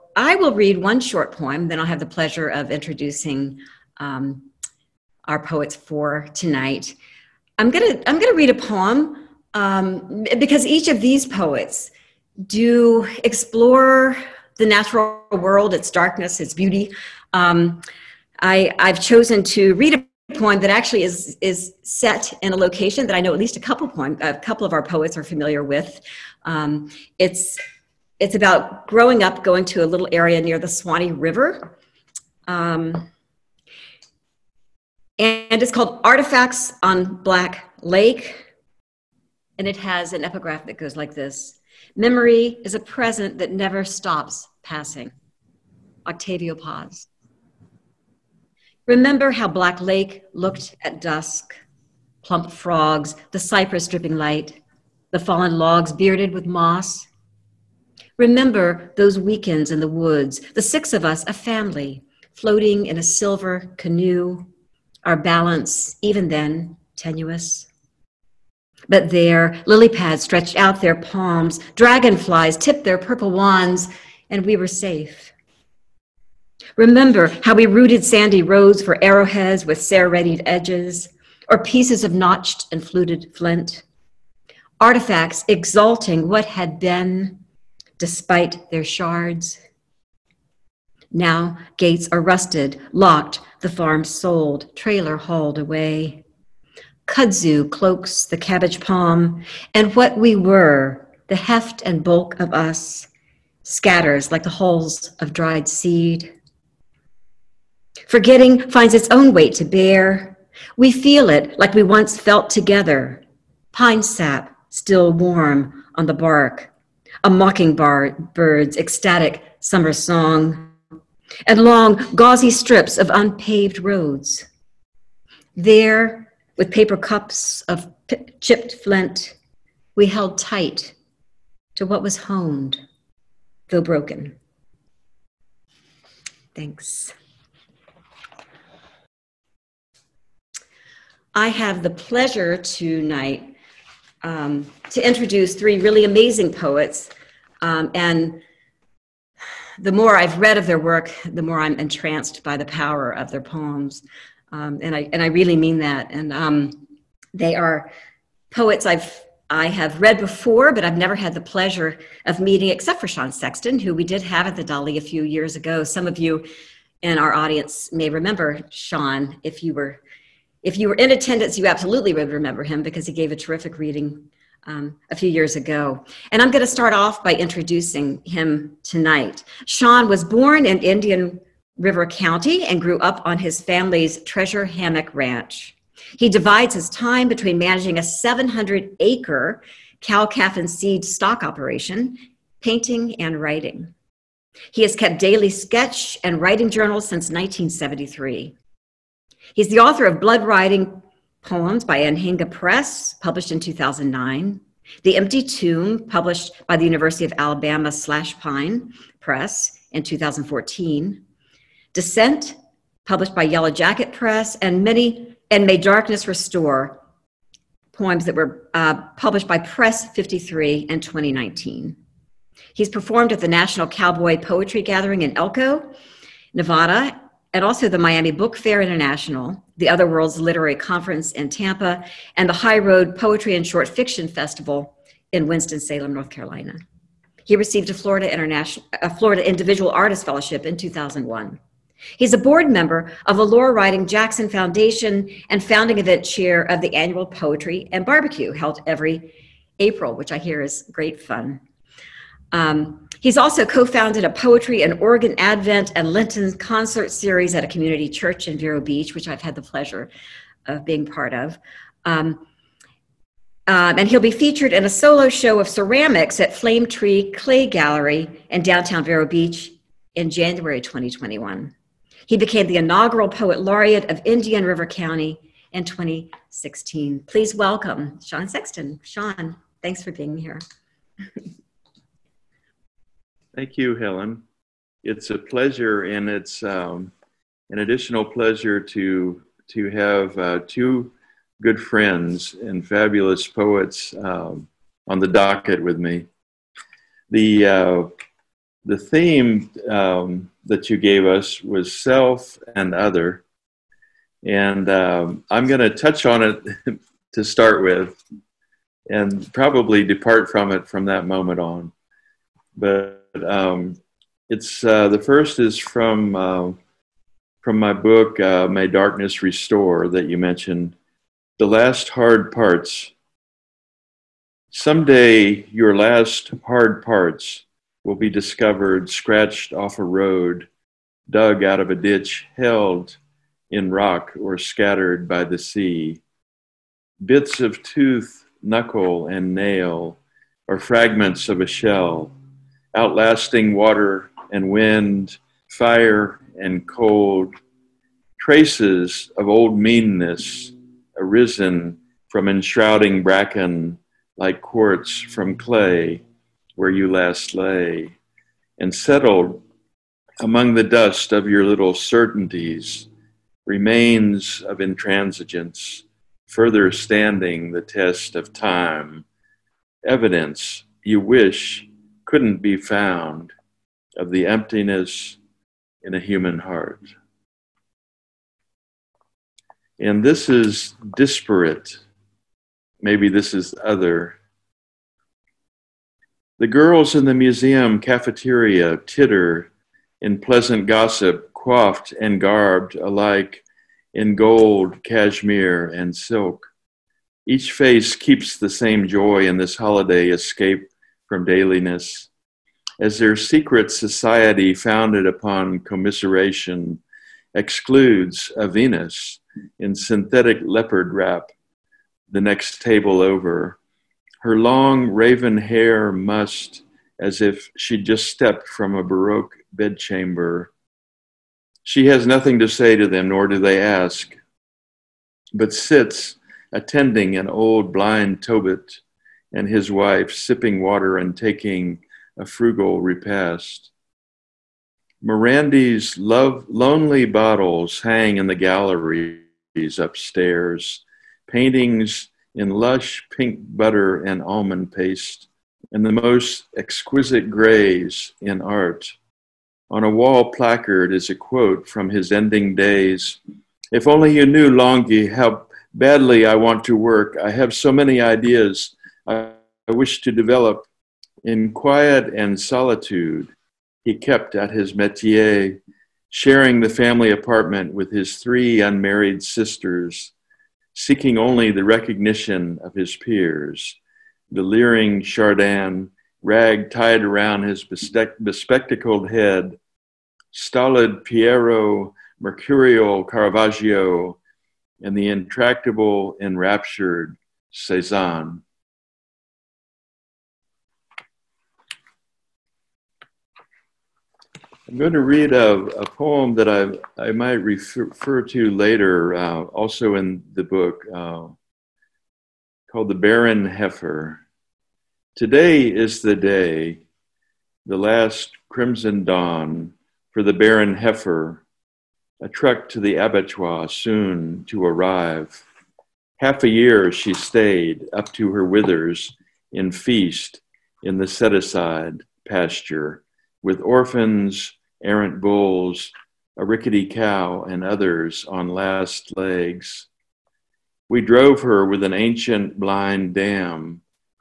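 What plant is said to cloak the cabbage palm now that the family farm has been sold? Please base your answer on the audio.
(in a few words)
kudzu.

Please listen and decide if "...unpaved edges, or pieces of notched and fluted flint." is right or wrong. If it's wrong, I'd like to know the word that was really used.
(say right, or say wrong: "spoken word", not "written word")
wrong: "serrated", not "unpaved".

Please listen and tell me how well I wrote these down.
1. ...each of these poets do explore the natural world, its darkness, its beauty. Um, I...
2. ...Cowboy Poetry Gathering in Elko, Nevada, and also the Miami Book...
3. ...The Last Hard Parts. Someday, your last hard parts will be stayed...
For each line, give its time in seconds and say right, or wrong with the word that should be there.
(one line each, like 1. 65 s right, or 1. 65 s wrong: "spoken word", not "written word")
1. 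10 s right
2. 223 s right
3. 321 s wrong: "discovered", not "stayed".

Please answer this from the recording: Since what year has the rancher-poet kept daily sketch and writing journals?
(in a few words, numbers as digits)
1973.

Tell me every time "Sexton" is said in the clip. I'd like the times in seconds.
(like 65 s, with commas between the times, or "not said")
163 s, 278 s.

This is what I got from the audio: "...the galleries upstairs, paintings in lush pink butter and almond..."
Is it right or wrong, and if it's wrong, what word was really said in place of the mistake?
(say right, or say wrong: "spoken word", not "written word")
right.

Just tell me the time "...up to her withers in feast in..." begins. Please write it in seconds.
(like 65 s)
518 s.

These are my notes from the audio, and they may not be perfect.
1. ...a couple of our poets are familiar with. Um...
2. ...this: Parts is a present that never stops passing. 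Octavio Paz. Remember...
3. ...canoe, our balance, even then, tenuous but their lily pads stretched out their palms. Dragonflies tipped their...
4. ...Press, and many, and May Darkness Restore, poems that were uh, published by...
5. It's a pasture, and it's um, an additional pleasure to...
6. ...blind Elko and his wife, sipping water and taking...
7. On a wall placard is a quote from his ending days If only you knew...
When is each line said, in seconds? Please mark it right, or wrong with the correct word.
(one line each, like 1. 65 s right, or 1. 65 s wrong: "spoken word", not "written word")
1. 24 s right
2. 41 s wrong: "Memory", not "Parts"
3. 63 s right
4. 214 s right
5. 285 s wrong: "pleasure", not "pasture"
6. 427 s wrong: "Tobit", not "Elko"
7. 449 s right.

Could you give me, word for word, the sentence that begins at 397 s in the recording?
Each face keeps the same joy in this holiday escape from dailiness.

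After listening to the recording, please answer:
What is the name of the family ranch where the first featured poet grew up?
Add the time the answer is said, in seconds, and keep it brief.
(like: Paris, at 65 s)
Treasure Hammock Ranch, at 184 s.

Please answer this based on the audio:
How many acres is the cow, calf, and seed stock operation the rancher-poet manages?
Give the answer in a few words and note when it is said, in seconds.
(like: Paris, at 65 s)
700, at 188 s.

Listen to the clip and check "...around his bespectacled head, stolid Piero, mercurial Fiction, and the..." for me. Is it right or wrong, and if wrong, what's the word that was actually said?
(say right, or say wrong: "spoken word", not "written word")
wrong: "Caravaggio", not "Fiction".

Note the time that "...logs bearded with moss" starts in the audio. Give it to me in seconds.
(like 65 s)
55 s.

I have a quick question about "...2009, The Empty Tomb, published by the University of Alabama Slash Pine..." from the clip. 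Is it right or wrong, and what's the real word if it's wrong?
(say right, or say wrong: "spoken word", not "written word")
right.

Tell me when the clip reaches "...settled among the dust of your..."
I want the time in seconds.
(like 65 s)
358 s.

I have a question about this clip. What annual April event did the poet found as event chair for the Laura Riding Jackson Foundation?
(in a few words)
Poetry and Barbecue.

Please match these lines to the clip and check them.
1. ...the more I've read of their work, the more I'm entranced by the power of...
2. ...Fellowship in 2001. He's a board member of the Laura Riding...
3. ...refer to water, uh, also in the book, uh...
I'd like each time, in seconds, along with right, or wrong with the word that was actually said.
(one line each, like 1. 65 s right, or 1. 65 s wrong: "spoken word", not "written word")
1. 149 s right
2. 240 s right
3. 498 s wrong: "later", not "water".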